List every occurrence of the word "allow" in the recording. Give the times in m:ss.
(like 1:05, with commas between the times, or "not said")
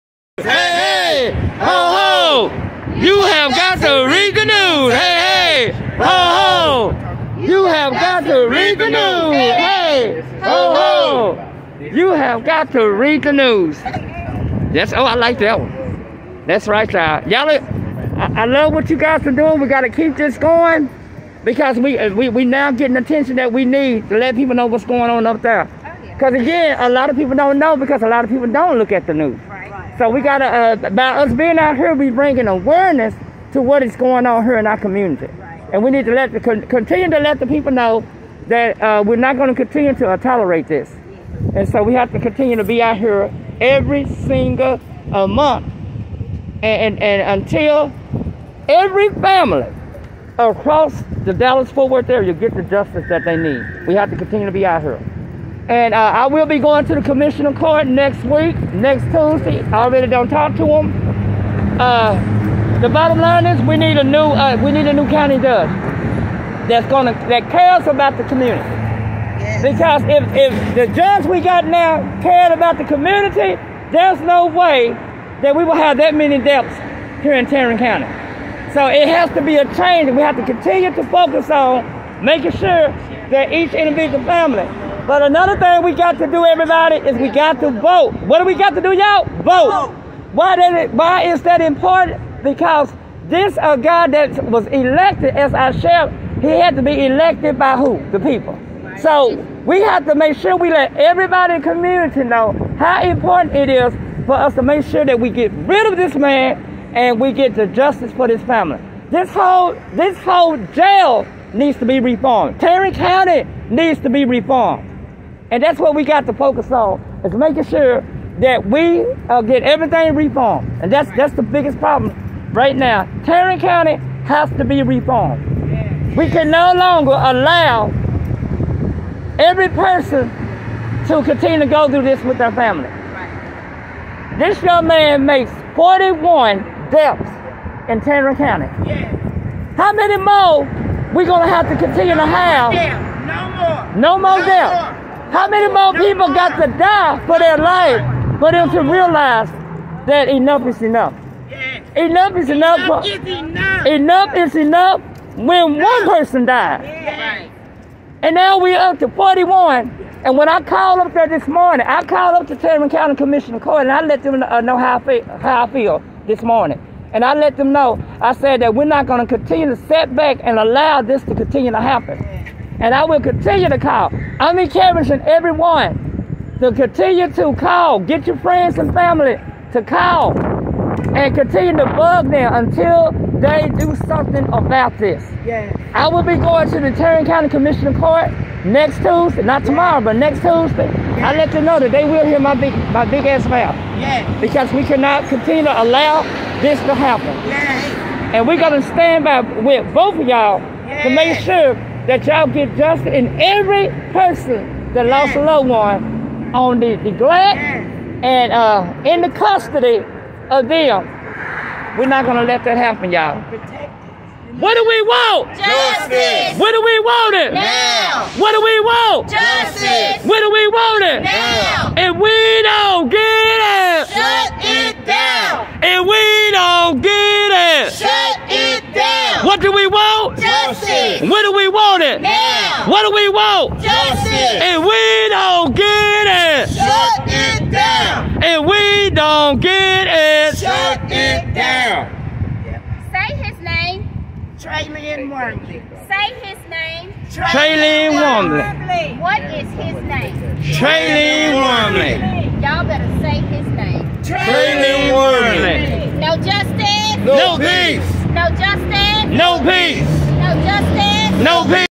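2:07, 2:50, 3:15.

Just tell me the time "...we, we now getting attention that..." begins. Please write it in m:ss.
0:22.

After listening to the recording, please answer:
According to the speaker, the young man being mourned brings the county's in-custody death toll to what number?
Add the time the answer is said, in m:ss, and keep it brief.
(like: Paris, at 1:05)
41, at 2:14.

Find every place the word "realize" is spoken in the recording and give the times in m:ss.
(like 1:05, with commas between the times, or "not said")
2:28.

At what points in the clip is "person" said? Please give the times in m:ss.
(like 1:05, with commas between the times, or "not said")
2:09, 2:36, 3:24.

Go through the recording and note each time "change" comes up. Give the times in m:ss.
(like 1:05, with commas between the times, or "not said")
1:19.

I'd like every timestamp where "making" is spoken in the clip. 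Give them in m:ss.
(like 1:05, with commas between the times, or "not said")
1:22, 1:57.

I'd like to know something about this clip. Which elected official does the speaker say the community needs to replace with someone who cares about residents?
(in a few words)
County judge.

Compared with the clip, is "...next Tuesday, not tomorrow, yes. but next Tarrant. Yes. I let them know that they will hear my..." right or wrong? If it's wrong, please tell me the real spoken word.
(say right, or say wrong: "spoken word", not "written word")
wrong: "Tuesday", not "Tarrant".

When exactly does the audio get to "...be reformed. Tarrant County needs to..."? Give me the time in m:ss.
1:51.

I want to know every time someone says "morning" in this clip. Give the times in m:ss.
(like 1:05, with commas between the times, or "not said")
2:41, 2:46.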